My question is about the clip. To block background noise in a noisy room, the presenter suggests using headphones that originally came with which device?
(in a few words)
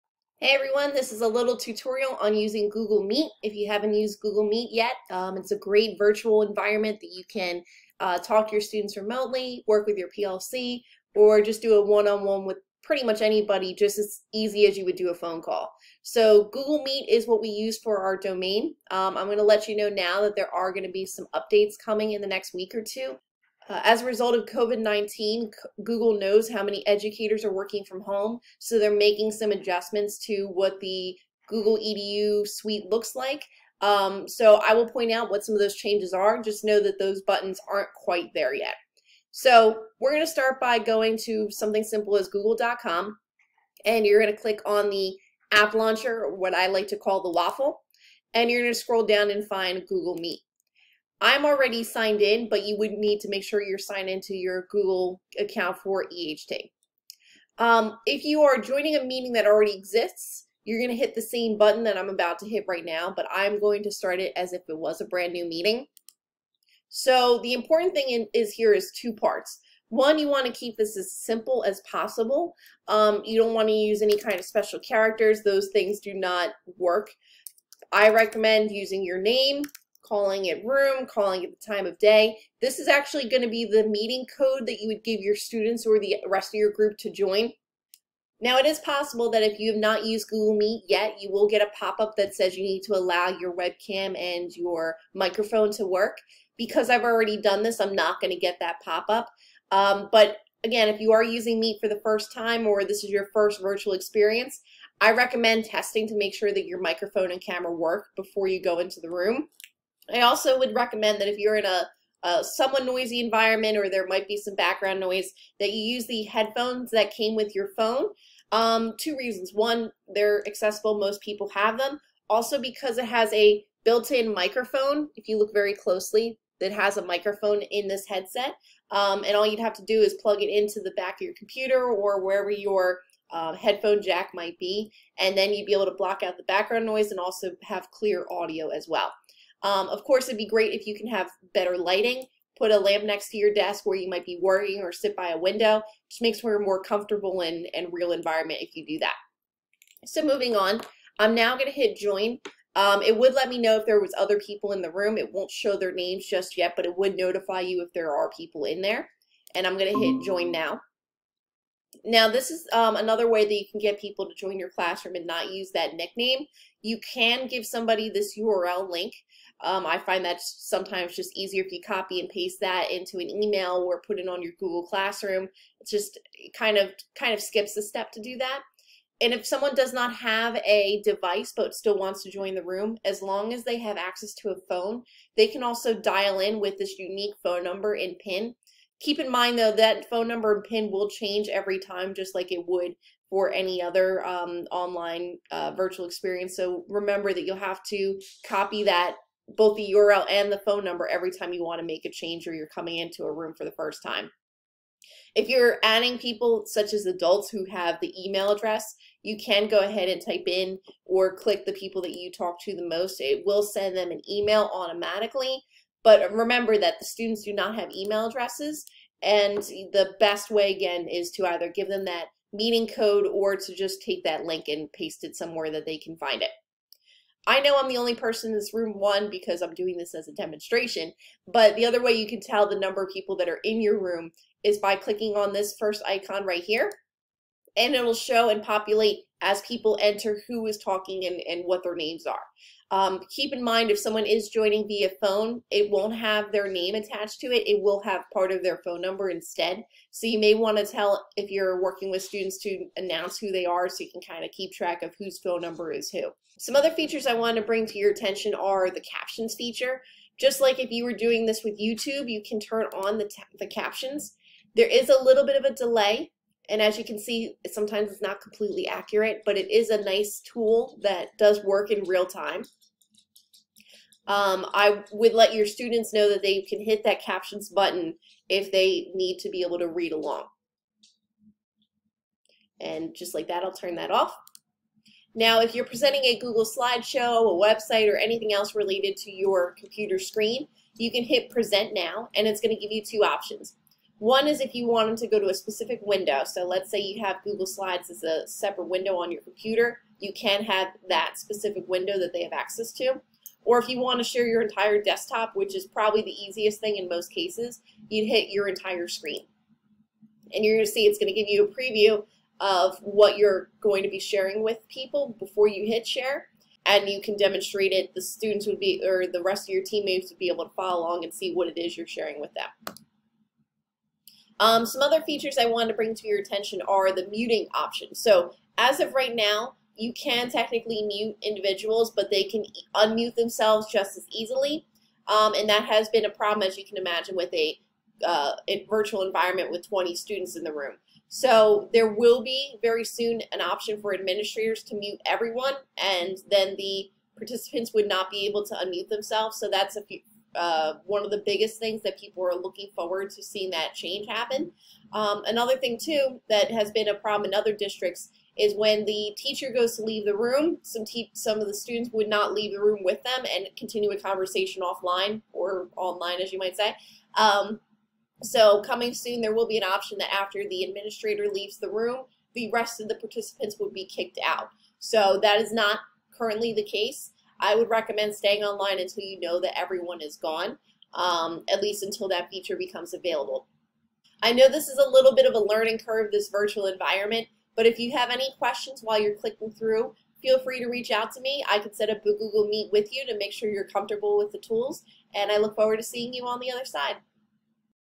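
your phone.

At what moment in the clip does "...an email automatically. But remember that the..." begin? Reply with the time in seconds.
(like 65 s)
214 s.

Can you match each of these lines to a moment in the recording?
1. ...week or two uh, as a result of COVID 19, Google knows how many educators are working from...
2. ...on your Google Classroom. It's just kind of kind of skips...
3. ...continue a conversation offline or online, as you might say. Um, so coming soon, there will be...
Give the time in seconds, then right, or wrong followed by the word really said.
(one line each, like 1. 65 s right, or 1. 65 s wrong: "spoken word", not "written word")
1. 22 s right
2. 174 s right
3. 363 s right.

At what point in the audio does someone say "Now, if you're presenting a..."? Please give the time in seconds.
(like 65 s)
285 s.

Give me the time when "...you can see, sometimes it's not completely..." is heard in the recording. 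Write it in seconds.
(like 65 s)
266 s.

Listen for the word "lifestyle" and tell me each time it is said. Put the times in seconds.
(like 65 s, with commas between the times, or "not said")
not said.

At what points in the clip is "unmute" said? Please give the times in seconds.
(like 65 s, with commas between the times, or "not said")
332 s, 348 s.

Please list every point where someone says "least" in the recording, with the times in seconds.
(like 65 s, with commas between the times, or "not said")
381 s.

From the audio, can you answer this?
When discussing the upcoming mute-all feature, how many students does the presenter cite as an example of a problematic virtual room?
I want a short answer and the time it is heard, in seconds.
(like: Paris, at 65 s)
20, at 339 s.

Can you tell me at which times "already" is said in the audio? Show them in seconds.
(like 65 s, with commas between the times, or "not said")
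51 s, 59 s, 97 s.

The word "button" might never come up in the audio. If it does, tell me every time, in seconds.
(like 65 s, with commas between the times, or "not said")
37 s, 61 s, 277 s.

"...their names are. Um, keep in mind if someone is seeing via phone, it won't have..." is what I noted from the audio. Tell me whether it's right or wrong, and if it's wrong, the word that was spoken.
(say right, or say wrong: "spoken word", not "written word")
wrong: "joining", not "seeing".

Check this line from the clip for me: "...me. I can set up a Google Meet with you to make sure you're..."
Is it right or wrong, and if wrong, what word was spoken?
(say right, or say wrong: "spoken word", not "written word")
right.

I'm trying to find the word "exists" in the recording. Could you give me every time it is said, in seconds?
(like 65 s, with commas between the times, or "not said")
59 s.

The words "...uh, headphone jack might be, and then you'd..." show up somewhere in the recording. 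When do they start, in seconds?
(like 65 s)
133 s.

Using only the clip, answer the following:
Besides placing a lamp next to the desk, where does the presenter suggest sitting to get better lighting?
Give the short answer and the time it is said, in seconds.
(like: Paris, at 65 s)
by a window, at 145 s.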